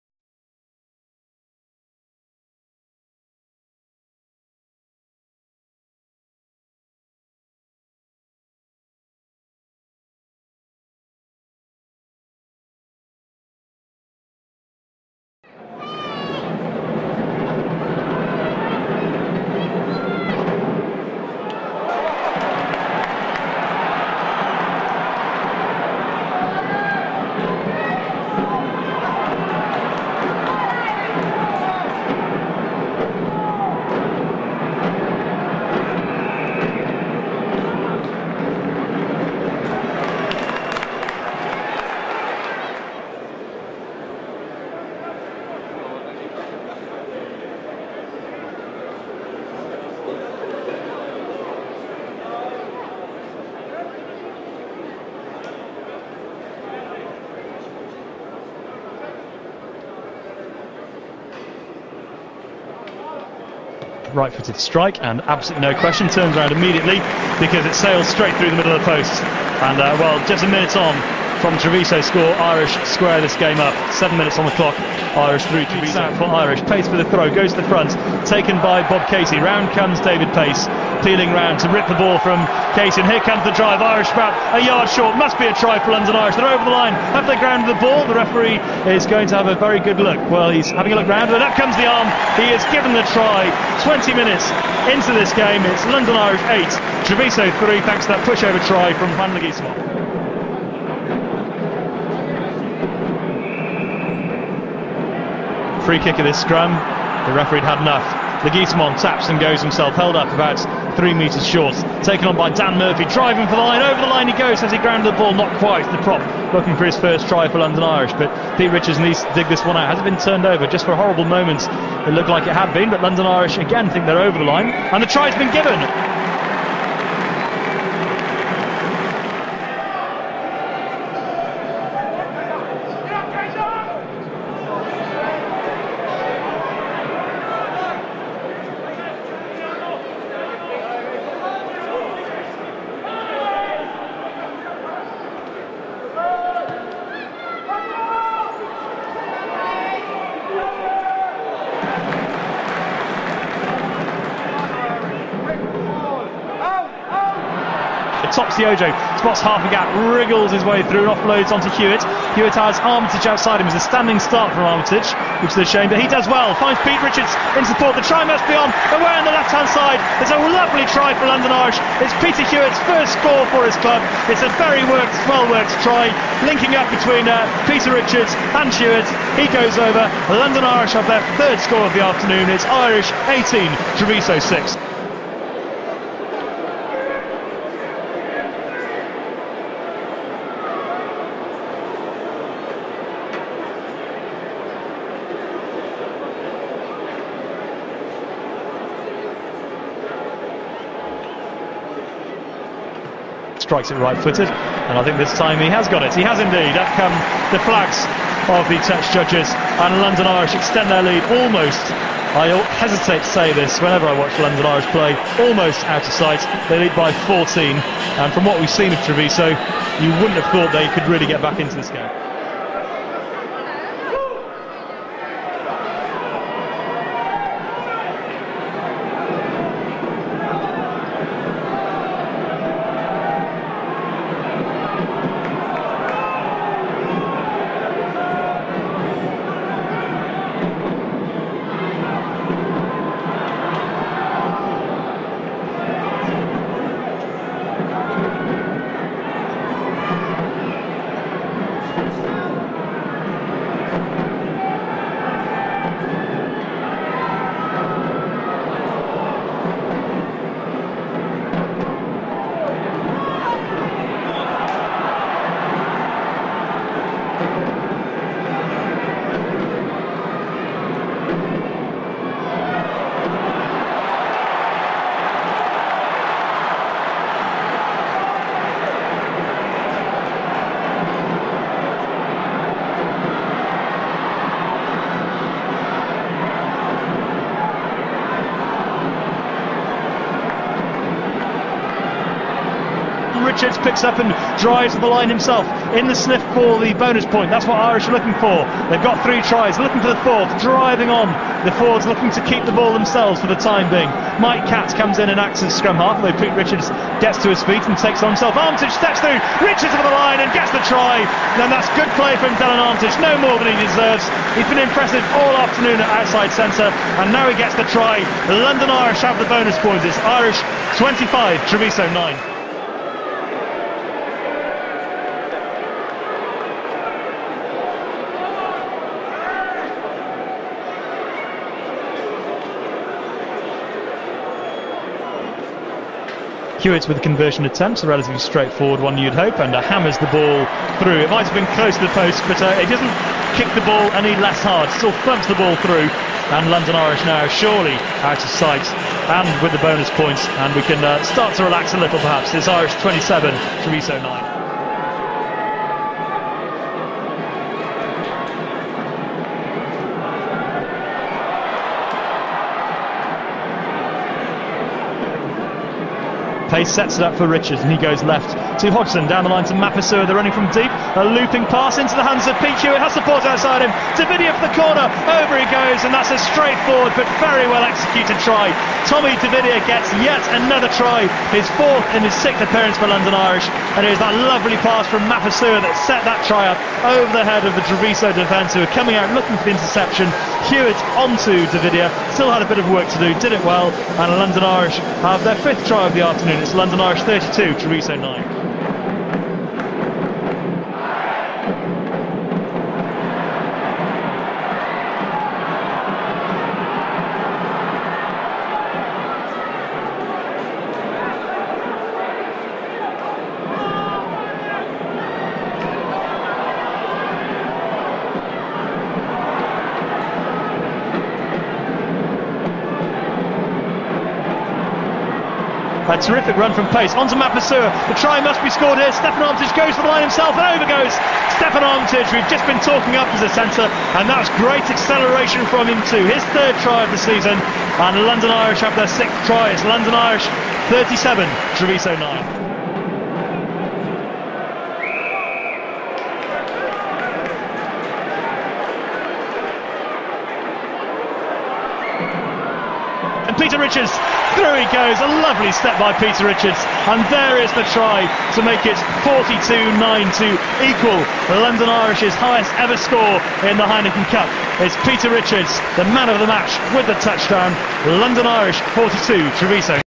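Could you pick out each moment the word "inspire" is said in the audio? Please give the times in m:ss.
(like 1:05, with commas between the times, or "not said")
not said.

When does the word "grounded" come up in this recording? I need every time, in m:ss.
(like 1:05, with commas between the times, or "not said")
1:27, 1:54.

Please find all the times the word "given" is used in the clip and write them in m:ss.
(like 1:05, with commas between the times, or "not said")
1:32, 2:05.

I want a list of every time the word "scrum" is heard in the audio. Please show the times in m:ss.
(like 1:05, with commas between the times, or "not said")
1:46, 5:05.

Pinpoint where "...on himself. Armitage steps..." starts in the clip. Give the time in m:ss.
5:08.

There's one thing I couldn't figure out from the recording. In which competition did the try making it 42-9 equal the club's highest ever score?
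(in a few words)
Heineken Cup.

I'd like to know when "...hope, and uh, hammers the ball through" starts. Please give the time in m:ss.
5:39.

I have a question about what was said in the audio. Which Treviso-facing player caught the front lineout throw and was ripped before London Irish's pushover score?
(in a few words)
Bob Casey.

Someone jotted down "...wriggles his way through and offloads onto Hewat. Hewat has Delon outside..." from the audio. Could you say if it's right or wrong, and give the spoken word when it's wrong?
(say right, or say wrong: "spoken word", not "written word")
wrong: "Armitage", not "Delon".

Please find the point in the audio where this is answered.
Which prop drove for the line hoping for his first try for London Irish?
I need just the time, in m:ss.
1:52.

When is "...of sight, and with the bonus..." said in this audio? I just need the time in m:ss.
5:48.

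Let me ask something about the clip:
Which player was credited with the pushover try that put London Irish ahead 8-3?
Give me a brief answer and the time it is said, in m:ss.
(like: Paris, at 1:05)
Juan Leguizamon, at 1:39.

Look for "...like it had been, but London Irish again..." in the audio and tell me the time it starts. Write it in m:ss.
2:02.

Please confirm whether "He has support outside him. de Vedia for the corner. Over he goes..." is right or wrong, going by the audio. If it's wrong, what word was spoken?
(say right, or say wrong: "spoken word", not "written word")
right.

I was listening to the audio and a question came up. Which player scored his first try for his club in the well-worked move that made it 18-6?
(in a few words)
Peter Hewat.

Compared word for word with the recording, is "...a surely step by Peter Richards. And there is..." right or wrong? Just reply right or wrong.
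wrong.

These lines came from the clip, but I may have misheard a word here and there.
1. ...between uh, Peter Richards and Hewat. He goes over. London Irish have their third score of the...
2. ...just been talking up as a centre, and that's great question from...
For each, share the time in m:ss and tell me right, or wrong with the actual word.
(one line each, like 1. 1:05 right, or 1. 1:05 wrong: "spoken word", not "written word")
1. 2:56 right
2. 7:12 wrong: "acceleration", not "question".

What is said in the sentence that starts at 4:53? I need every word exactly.
picks up and drives the line himself in the sniff for the bonus point.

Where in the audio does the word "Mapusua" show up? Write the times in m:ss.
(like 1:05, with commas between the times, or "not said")
6:09, 6:25, 7:07.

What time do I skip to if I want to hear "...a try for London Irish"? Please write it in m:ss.
1:25.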